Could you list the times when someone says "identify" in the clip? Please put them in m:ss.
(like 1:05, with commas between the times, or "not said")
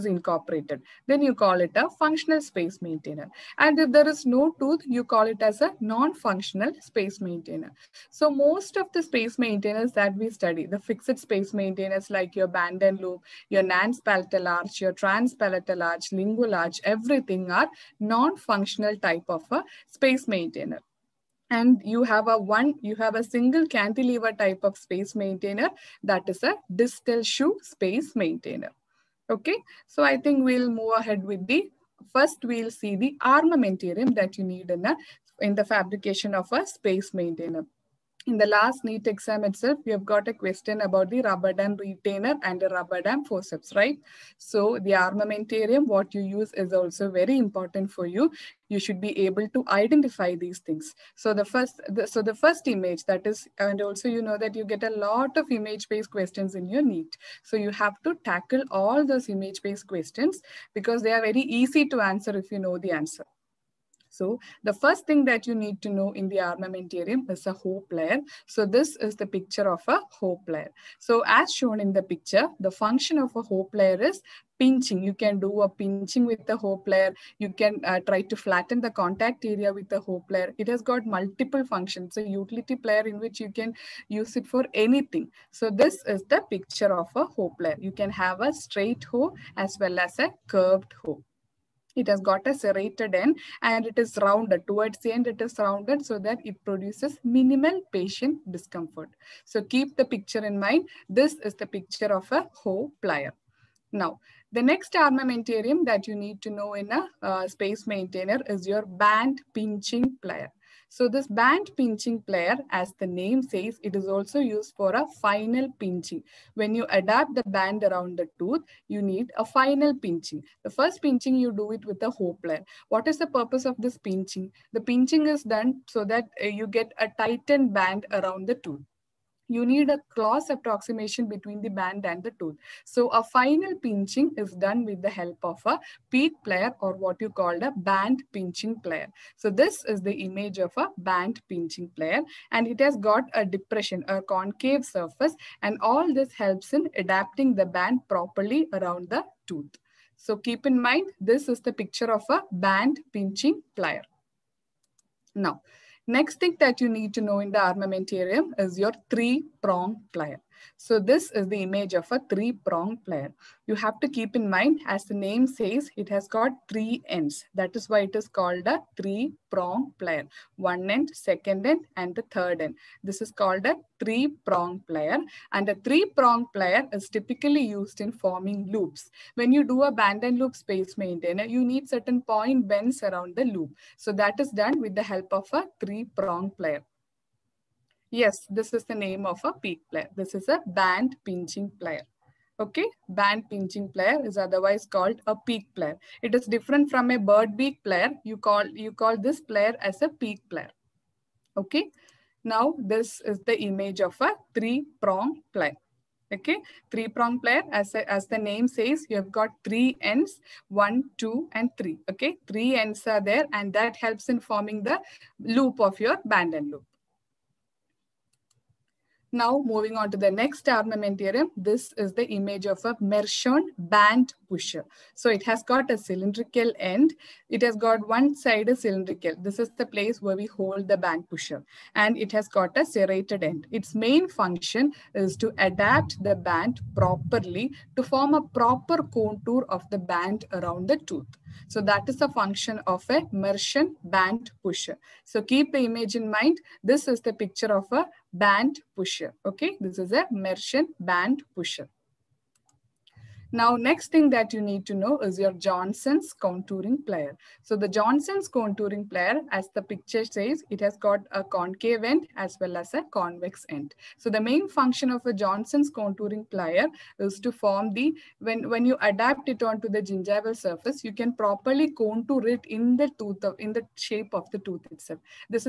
0:49.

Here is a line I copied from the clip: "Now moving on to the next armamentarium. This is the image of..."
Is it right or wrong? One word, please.
right.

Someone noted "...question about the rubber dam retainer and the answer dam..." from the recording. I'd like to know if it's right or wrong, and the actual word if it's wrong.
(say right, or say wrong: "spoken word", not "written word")
wrong: "rubber", not "answer".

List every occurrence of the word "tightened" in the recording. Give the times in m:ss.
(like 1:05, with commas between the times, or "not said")
2:07.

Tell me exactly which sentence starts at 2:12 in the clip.
So a final pinching is done with the help of a peak plier or what you called a band pinching plier.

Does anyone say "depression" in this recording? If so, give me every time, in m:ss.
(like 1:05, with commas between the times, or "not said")
2:23.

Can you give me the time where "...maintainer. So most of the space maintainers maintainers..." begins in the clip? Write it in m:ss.
0:07.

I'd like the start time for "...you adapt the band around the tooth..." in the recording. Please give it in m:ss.
1:56.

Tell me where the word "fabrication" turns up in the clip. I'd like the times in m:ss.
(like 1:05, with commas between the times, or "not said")
0:35.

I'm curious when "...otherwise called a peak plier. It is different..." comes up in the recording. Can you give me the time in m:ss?
3:14.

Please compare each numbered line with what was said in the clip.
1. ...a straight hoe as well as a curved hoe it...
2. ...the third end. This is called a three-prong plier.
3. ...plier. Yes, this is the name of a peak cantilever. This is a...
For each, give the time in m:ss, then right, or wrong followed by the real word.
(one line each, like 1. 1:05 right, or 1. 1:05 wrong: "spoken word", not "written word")
1. 1:28 right
2. 2:52 right
3. 3:06 wrong: "plier", not "cantilever".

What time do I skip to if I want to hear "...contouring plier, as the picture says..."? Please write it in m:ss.
4:18.